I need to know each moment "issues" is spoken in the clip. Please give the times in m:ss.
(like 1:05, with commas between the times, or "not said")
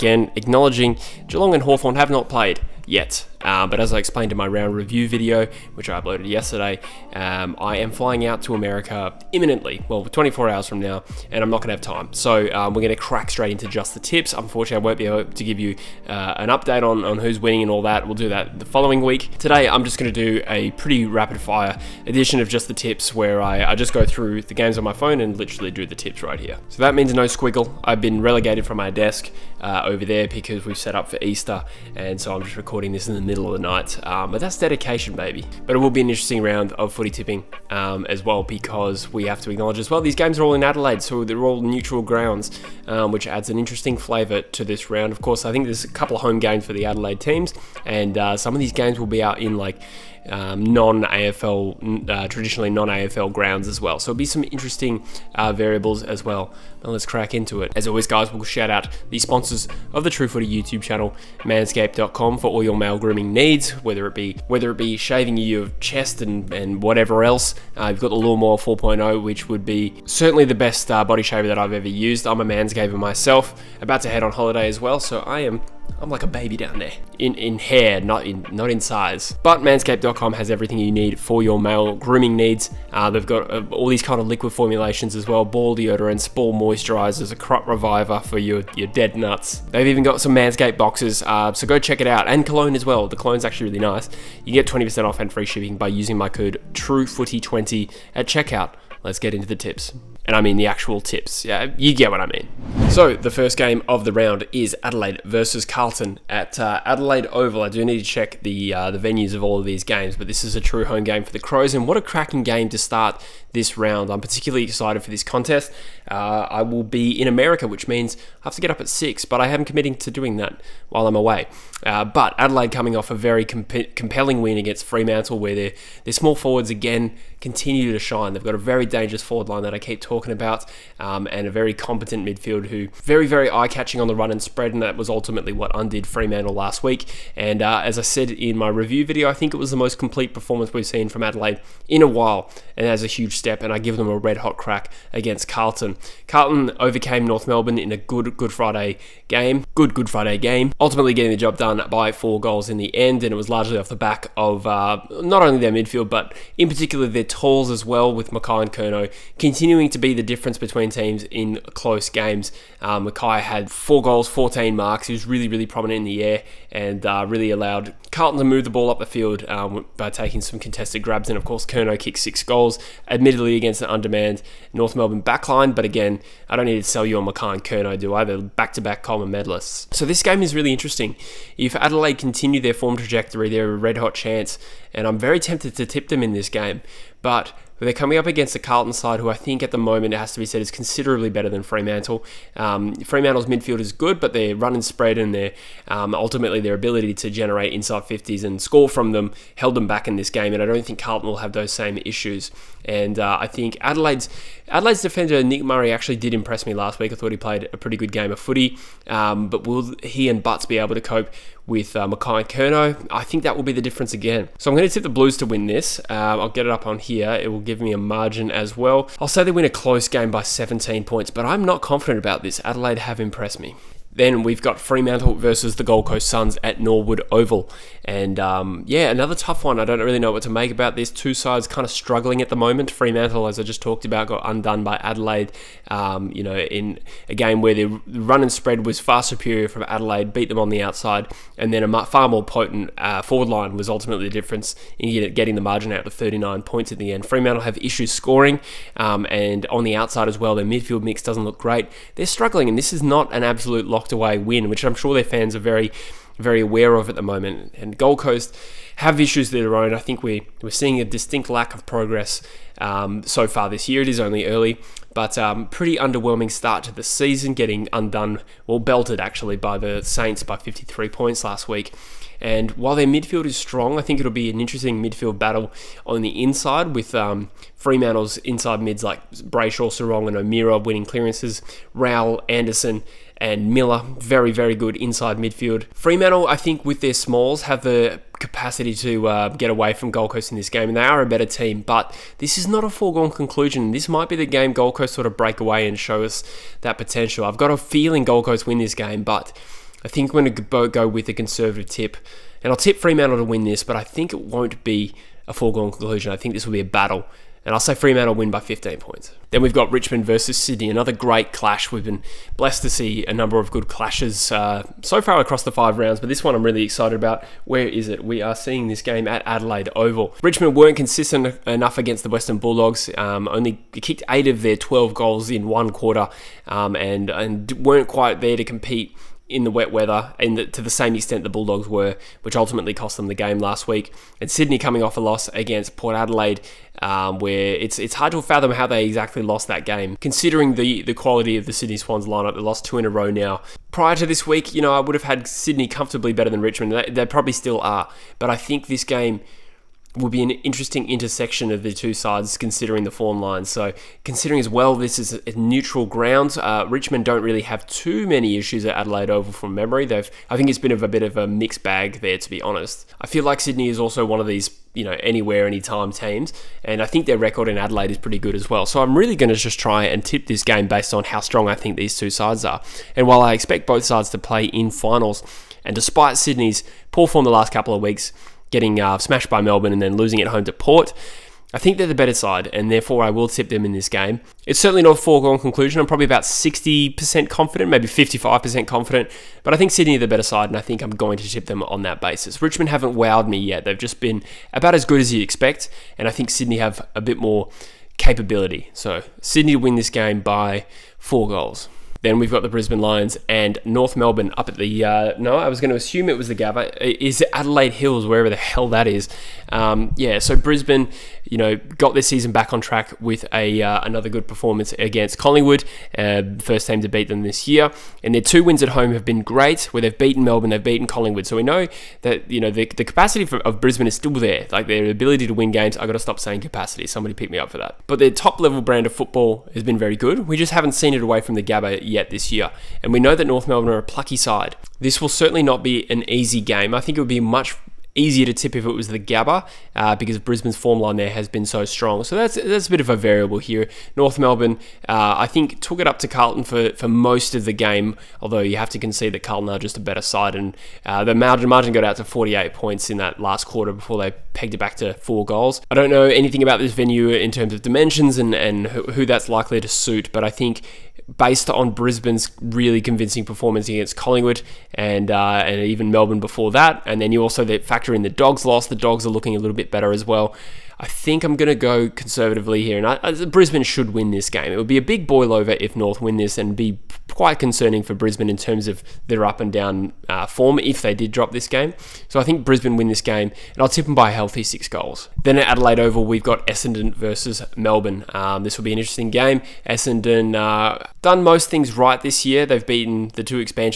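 3:22, 4:07, 4:19, 5:58.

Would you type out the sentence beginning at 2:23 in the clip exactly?
And I give them a red hot crack against Carlton.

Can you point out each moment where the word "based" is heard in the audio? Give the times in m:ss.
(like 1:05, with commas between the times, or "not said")
6:10, 7:41.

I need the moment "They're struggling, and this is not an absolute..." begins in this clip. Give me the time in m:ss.
4:12.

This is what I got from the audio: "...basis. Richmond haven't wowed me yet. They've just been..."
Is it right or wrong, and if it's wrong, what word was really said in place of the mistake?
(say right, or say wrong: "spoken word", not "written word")
right.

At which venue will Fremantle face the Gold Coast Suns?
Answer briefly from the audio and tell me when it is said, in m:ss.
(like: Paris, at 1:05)
Norwood Oval, at 3:46.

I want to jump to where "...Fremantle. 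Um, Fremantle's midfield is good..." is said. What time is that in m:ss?
3:11.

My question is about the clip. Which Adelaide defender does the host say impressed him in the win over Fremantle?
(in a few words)
Nick Murray.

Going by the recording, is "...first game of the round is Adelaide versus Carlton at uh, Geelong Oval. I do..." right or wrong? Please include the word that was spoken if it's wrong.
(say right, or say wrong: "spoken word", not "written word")
wrong: "Adelaide", not "Geelong".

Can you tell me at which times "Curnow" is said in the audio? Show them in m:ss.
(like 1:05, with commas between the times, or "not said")
2:38, 2:51, 2:57, 3:32.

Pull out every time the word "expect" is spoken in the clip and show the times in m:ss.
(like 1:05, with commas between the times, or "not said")
6:13, 6:35.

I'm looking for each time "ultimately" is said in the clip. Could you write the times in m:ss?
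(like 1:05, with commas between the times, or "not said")
2:15, 2:30, 3:16, 4:03, 5:32.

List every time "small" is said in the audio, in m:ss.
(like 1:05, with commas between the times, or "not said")
2:06, 4:47.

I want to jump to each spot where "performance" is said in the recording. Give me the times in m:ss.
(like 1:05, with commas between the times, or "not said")
2:20, 6:54, 7:43.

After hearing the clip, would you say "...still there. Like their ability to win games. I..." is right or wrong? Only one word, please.
right.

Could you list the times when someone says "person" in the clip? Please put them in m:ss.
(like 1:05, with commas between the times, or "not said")
not said.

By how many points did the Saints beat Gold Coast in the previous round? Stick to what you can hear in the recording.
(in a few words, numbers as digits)
53.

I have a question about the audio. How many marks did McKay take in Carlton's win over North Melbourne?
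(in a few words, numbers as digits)
14.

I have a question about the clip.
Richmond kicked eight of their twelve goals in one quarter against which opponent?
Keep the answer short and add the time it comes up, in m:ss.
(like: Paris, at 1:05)
Western Bulldogs, at 5:22.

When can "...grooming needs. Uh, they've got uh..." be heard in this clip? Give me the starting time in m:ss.
1:21.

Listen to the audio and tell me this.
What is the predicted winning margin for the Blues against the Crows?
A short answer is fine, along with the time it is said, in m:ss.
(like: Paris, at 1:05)
17 points, at 3:40.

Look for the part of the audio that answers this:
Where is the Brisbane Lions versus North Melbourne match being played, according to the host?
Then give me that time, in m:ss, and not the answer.
6:47.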